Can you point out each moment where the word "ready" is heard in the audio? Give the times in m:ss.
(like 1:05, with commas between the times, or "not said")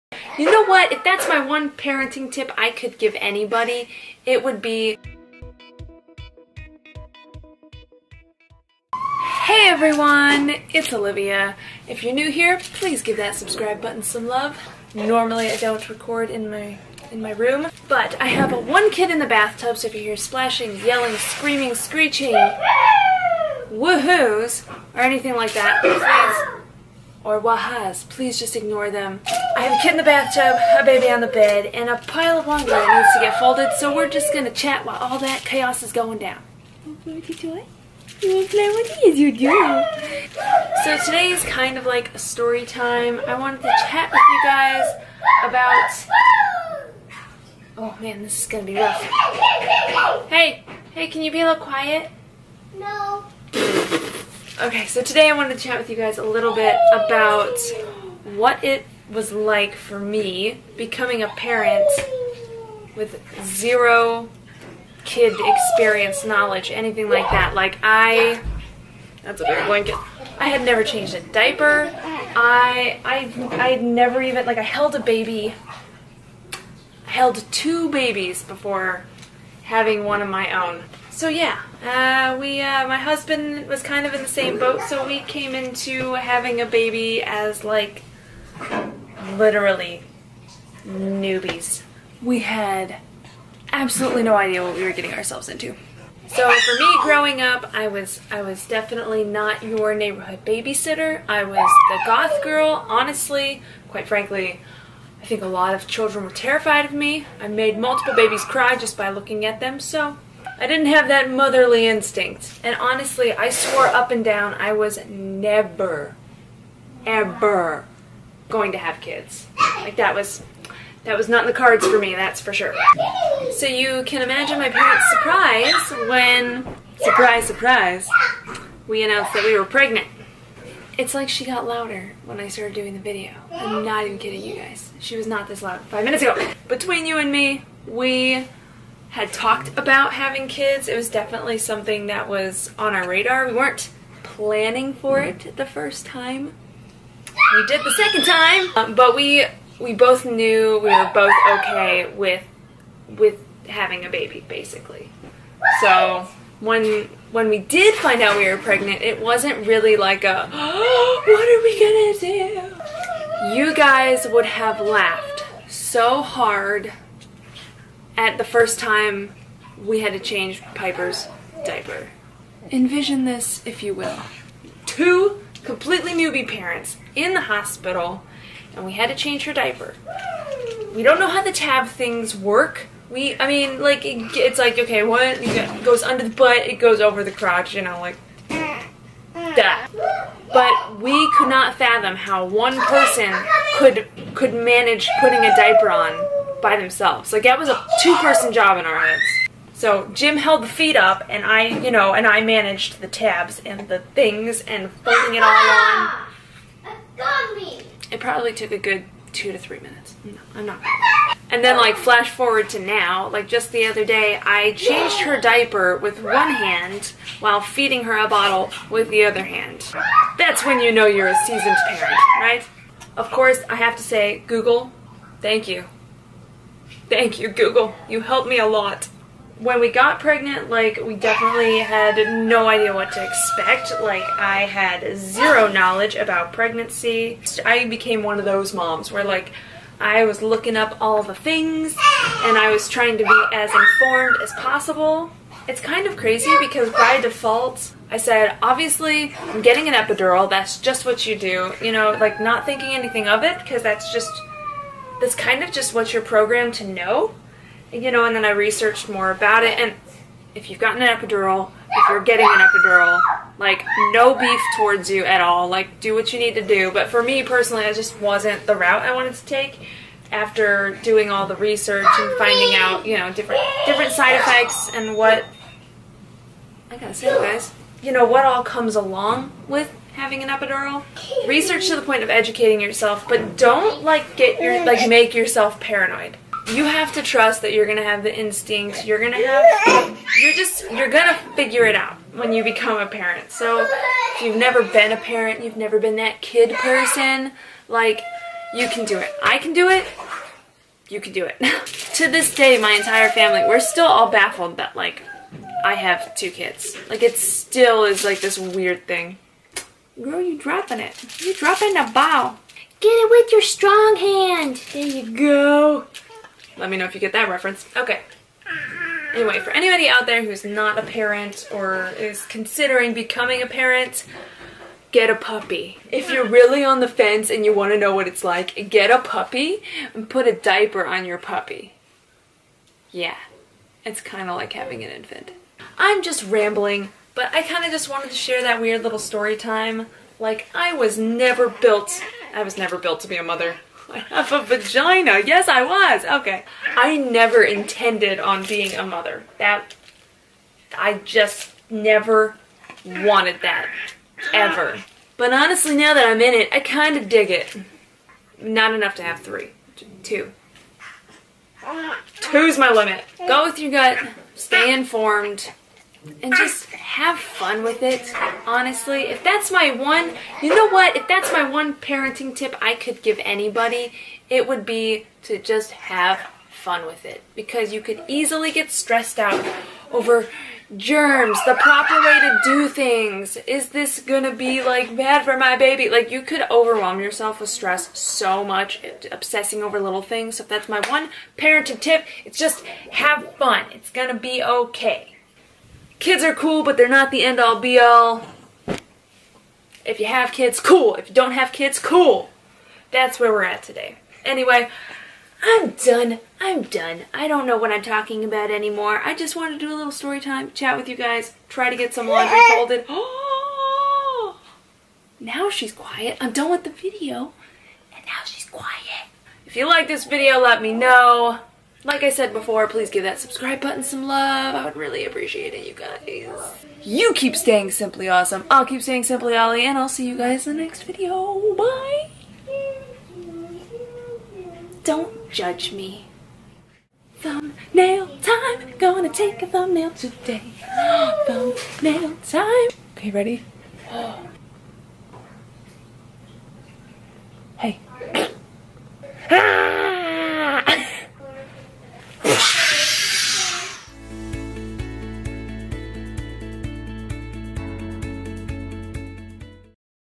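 7:23.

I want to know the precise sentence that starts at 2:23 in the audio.
We weren't planning for it the first time.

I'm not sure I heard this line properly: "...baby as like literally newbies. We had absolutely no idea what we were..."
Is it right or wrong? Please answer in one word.
right.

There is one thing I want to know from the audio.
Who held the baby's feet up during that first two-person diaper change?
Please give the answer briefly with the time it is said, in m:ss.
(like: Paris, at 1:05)
Jim, at 3:20.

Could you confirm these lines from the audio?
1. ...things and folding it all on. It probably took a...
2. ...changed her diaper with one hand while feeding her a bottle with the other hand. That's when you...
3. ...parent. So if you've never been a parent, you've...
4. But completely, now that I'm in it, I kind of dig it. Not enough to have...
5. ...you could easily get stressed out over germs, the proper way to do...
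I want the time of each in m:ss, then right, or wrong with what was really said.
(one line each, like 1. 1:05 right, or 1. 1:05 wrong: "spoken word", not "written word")
1. 3:23 right
2. 3:34 right
3. 4:53 right
4. 5:55 wrong: "honestly", not "completely"
5. 6:17 right.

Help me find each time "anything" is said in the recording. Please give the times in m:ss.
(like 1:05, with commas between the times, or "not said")
0:25, 1:06, 4:12.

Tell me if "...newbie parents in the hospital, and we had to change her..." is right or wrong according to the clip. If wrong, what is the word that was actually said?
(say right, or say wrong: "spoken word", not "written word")
right.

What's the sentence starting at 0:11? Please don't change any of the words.
If you're new here, please give that subscribe button some love.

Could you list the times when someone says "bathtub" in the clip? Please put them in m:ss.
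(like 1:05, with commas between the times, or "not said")
0:19, 0:30.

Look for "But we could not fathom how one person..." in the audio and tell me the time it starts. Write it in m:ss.
3:10.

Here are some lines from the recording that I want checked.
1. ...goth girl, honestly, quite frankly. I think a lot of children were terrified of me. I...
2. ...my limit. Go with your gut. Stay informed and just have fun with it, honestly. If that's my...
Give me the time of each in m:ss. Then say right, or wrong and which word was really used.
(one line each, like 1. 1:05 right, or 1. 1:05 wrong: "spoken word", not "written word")
1. 1:42 right
2. 6:02 right.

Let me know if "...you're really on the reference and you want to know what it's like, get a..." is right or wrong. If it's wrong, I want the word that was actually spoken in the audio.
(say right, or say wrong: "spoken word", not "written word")
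wrong: "fence", not "reference".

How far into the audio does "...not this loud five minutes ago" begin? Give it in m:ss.
2:15.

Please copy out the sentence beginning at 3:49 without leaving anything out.
When we got pregnant, like, we definitely had no idea what to expect.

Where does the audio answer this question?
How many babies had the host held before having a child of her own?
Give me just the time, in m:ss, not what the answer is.
1:17.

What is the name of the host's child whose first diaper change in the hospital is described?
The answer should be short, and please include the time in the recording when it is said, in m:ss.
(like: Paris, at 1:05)
Piper, at 2:50.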